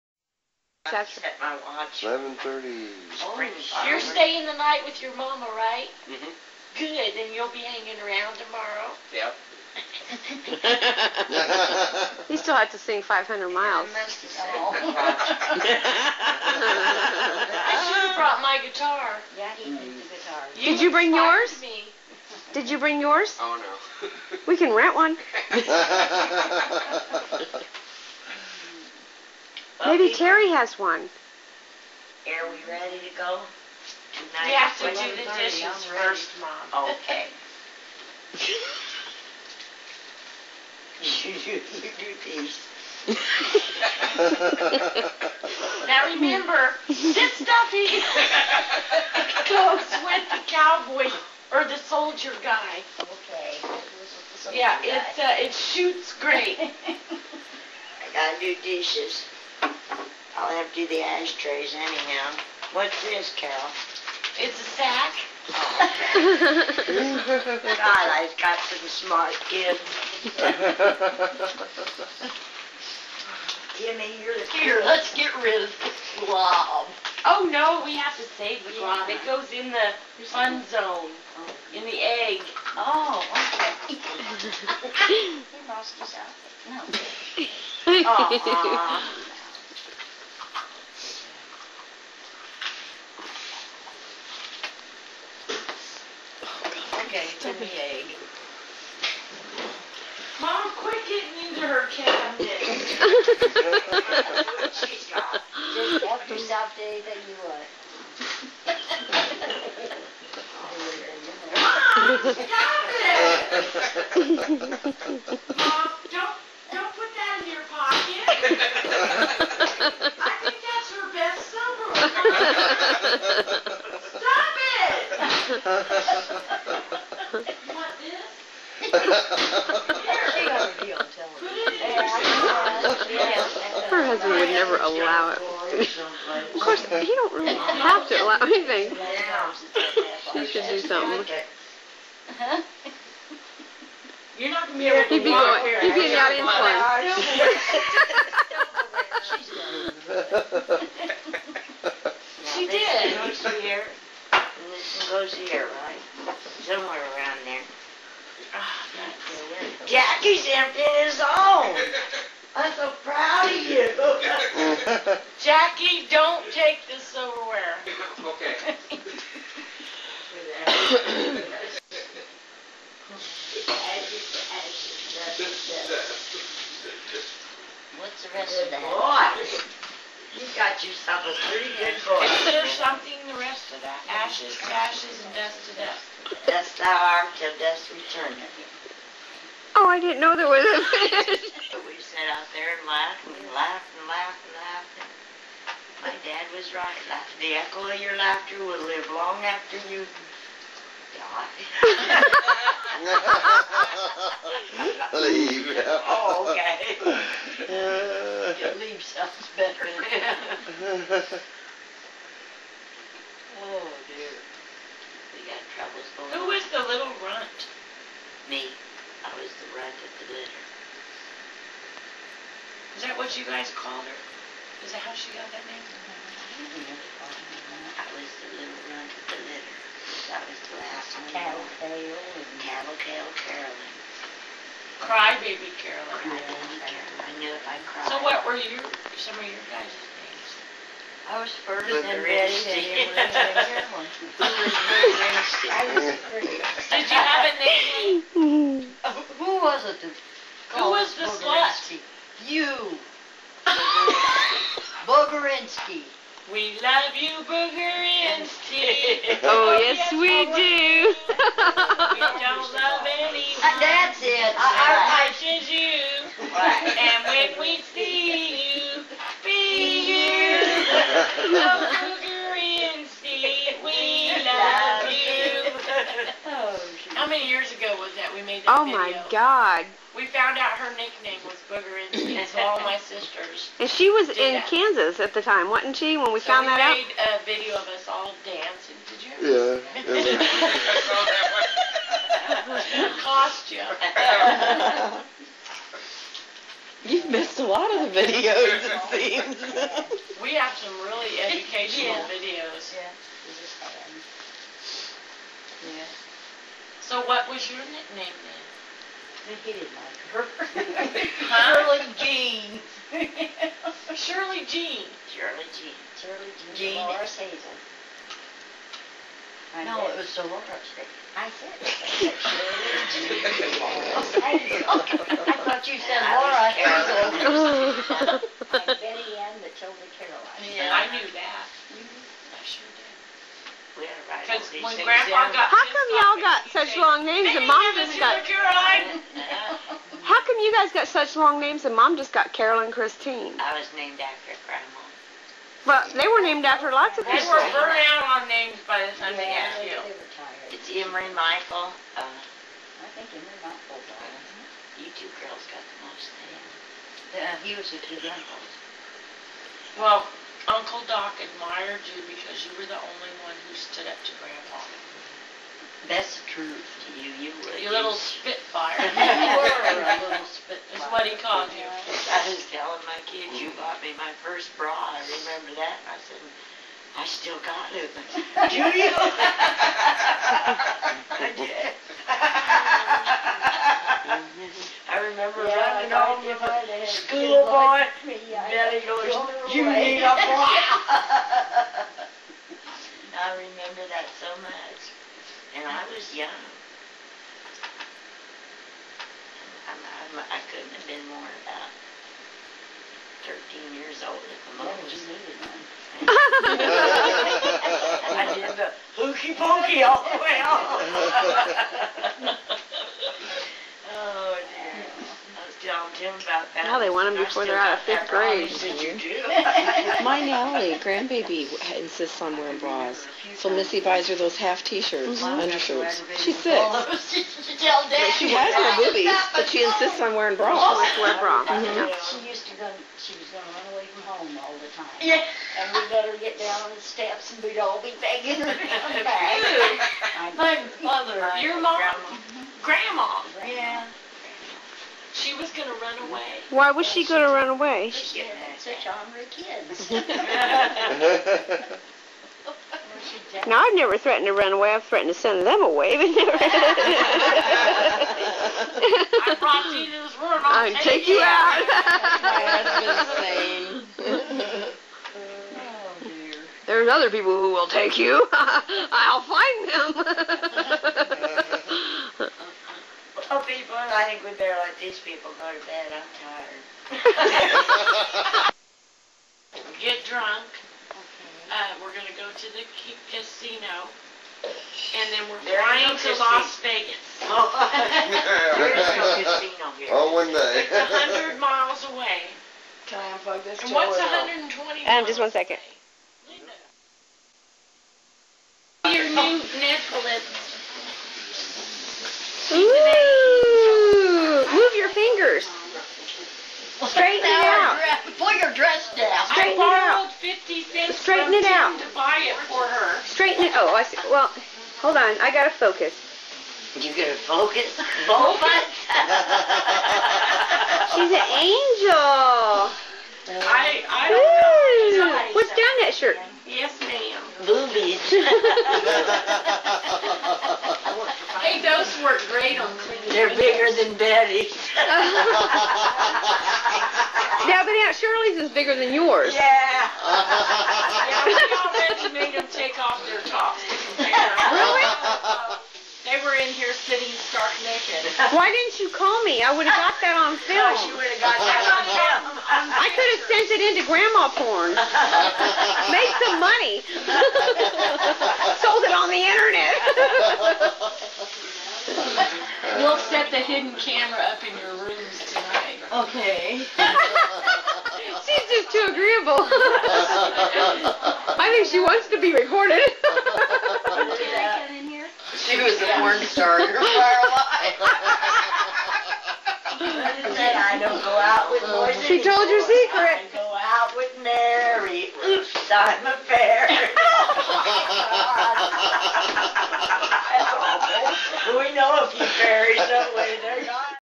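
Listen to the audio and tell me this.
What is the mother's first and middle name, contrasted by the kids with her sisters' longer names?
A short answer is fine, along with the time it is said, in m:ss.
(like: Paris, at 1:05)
Carolyn Christine, at 5:42.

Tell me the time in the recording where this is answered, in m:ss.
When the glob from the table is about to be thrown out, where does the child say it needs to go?
1:19.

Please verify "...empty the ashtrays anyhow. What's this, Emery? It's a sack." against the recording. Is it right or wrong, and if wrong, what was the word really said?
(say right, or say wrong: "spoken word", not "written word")
wrong: "Carol", not "Emery".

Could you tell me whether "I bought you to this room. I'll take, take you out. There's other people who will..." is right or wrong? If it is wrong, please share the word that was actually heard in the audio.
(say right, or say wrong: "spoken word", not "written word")
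wrong: "brought", not "bought".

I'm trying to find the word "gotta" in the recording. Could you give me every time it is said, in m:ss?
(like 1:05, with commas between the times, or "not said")
0:58, 8:35.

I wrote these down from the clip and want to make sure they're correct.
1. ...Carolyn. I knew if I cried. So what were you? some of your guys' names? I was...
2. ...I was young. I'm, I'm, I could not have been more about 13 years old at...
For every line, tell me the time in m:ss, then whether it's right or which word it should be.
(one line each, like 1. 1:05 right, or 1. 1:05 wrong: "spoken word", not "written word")
1. 3:56 right
2. 6:35 right.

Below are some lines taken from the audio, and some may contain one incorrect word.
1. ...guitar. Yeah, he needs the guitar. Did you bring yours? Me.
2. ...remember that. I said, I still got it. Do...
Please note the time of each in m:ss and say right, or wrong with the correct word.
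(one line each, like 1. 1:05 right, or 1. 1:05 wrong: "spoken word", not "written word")
1. 0:18 right
2. 6:15 right.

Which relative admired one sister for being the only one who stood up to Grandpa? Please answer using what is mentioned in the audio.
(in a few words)
Uncle Doc.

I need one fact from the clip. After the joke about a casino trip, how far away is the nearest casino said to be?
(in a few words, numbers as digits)
100 miles.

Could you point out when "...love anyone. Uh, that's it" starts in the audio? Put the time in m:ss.
4:22.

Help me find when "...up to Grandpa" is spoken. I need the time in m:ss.
6:04.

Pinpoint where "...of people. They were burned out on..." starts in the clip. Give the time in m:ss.
5:47.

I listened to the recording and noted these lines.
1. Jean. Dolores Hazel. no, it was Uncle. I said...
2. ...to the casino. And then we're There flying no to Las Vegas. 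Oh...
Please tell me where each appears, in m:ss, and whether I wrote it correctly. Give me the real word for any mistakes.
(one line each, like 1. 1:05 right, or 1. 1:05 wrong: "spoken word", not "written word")
1. 5:16 wrong: "Dolores", not "Uncle"
2. 8:02 right.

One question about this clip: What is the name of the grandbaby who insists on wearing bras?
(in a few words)
Natalie.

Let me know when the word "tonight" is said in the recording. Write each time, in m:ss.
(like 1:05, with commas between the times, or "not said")
0:34, 9:25.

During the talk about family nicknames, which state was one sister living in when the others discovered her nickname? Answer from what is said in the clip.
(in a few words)
Kansas.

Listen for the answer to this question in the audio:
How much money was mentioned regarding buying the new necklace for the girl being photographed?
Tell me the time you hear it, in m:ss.
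8:30.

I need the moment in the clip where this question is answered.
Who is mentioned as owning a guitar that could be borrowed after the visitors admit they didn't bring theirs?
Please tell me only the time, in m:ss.
0:30.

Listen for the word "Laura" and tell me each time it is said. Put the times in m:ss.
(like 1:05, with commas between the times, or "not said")
5:26.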